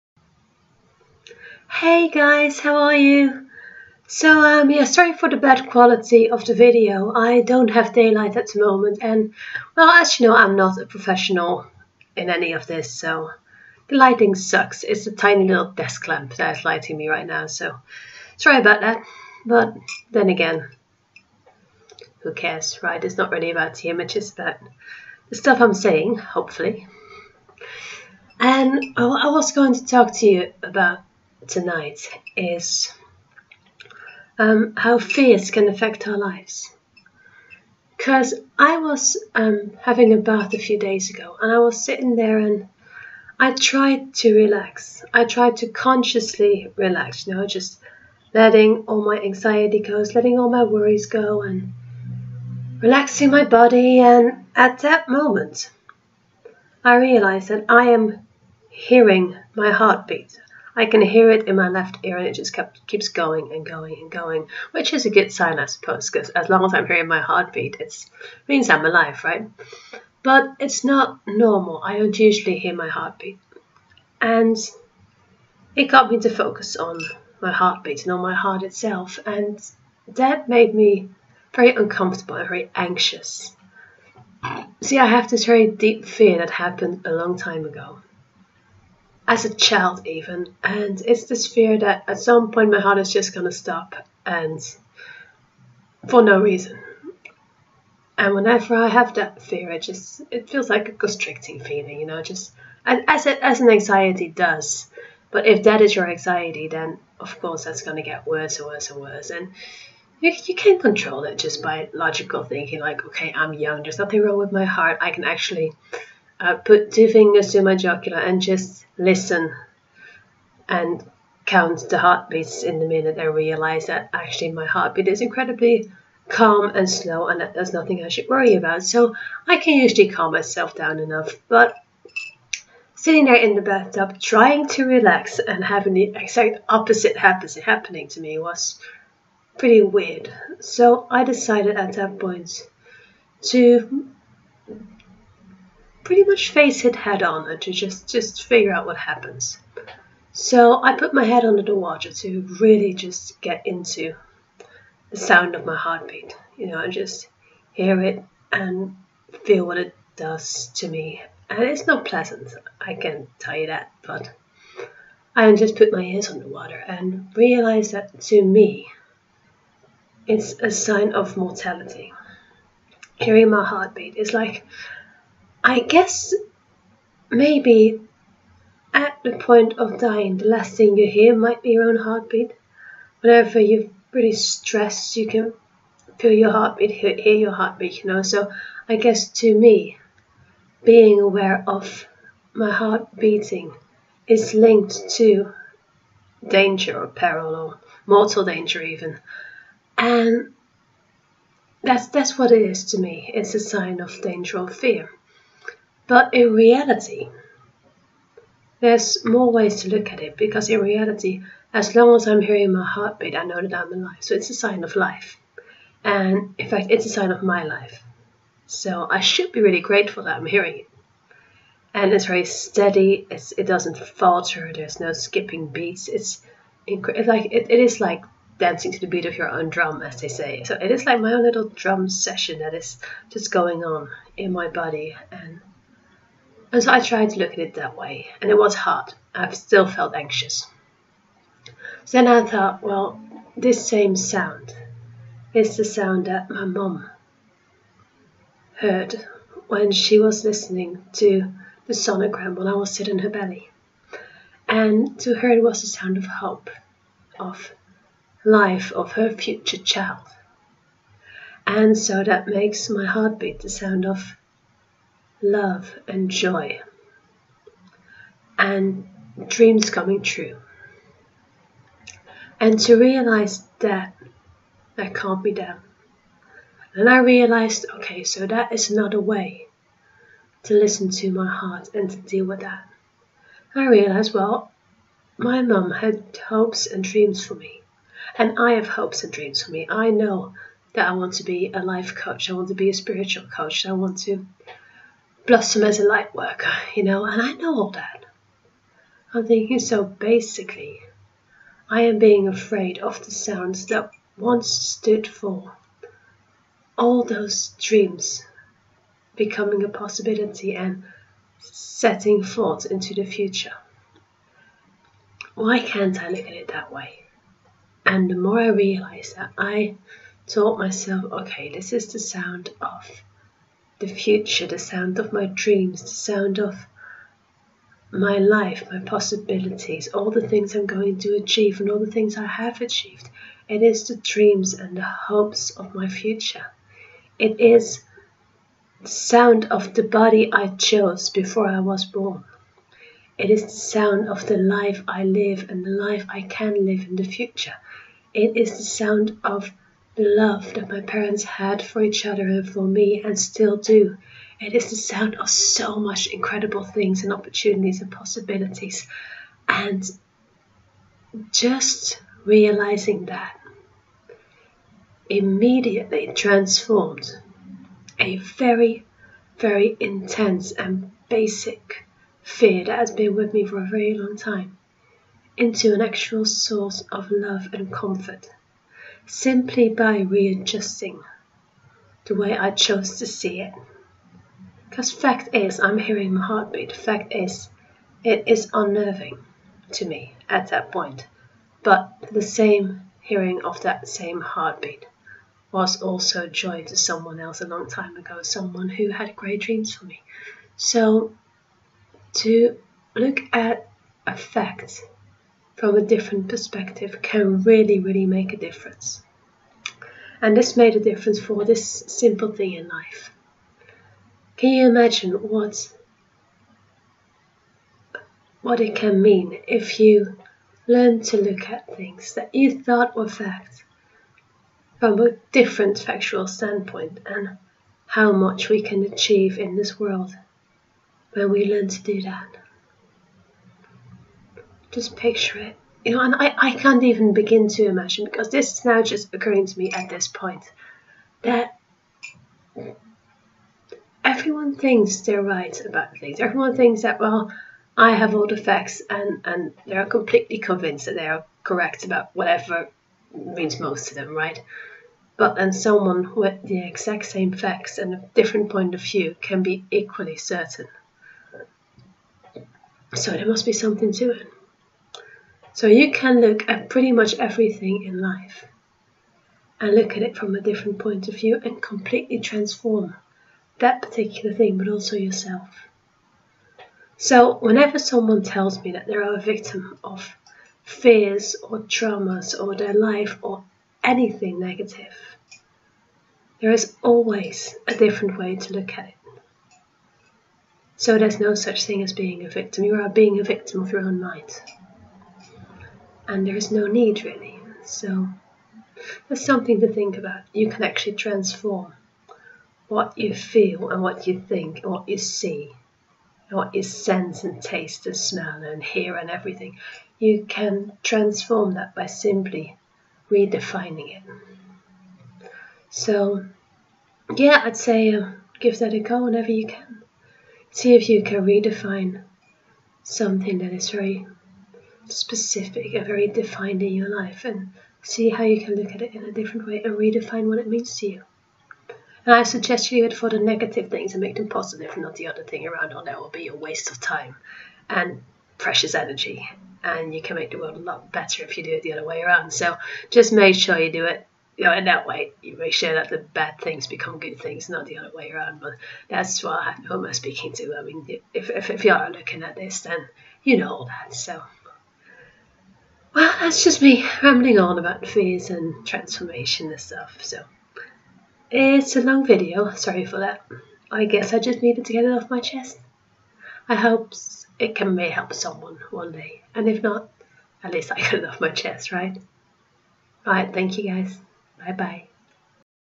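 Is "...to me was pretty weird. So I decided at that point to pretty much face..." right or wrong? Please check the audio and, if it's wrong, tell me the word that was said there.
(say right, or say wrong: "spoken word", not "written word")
right.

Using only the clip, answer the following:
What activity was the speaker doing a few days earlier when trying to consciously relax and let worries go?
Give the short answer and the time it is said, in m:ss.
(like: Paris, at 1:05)
Having a bath, at 0:39.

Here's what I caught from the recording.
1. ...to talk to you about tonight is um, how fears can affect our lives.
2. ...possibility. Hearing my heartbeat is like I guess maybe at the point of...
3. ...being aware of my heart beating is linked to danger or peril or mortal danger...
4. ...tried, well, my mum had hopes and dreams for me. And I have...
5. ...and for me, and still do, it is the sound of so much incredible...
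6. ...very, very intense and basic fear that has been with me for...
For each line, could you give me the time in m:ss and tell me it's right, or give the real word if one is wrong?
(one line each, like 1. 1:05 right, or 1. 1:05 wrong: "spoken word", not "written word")
1. 0:29 right
2. 2:51 wrong: "mortality", not "possibility"
3. 3:10 right
4. 4:43 wrong: "realized", not "tried"
5. 5:52 right
6. 6:08 right.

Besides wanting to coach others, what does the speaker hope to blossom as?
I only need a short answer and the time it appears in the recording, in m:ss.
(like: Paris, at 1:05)
A light worker, at 4:56.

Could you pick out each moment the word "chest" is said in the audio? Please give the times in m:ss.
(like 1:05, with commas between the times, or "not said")
9:25, 9:31.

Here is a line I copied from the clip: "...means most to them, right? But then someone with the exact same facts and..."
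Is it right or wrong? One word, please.
right.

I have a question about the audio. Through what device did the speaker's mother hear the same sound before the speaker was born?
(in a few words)
Sonogram.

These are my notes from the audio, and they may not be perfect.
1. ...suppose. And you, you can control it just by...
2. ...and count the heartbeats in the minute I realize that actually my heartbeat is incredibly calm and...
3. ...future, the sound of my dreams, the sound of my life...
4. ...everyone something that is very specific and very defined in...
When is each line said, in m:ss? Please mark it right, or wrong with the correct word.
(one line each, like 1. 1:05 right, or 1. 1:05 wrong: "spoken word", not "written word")
1. 1:48 wrong: "worse", not "suppose"
2. 2:00 right
3. 5:24 right
4. 8:41 wrong: "redefine", not "everyone".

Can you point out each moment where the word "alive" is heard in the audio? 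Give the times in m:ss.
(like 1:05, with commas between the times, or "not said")
1:08, 3:33.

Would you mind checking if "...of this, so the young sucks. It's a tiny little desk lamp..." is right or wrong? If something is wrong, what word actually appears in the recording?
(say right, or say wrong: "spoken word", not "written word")
wrong: "lighting", not "young".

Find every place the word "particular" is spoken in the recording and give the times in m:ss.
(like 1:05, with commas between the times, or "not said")
7:54.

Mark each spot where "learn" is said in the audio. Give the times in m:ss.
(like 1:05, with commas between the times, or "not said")
7:00, 7:11.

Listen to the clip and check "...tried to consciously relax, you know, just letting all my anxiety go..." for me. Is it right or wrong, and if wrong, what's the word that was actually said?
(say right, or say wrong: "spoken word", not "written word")
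right.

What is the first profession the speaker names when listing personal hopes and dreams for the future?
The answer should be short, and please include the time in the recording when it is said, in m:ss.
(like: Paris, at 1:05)
Life coach, at 4:51.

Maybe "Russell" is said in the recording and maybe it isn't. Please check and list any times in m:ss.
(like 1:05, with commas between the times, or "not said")
not said.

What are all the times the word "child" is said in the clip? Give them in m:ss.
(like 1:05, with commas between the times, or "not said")
1:29, 4:19.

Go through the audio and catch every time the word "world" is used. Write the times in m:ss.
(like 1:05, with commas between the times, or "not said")
7:09, 9:00.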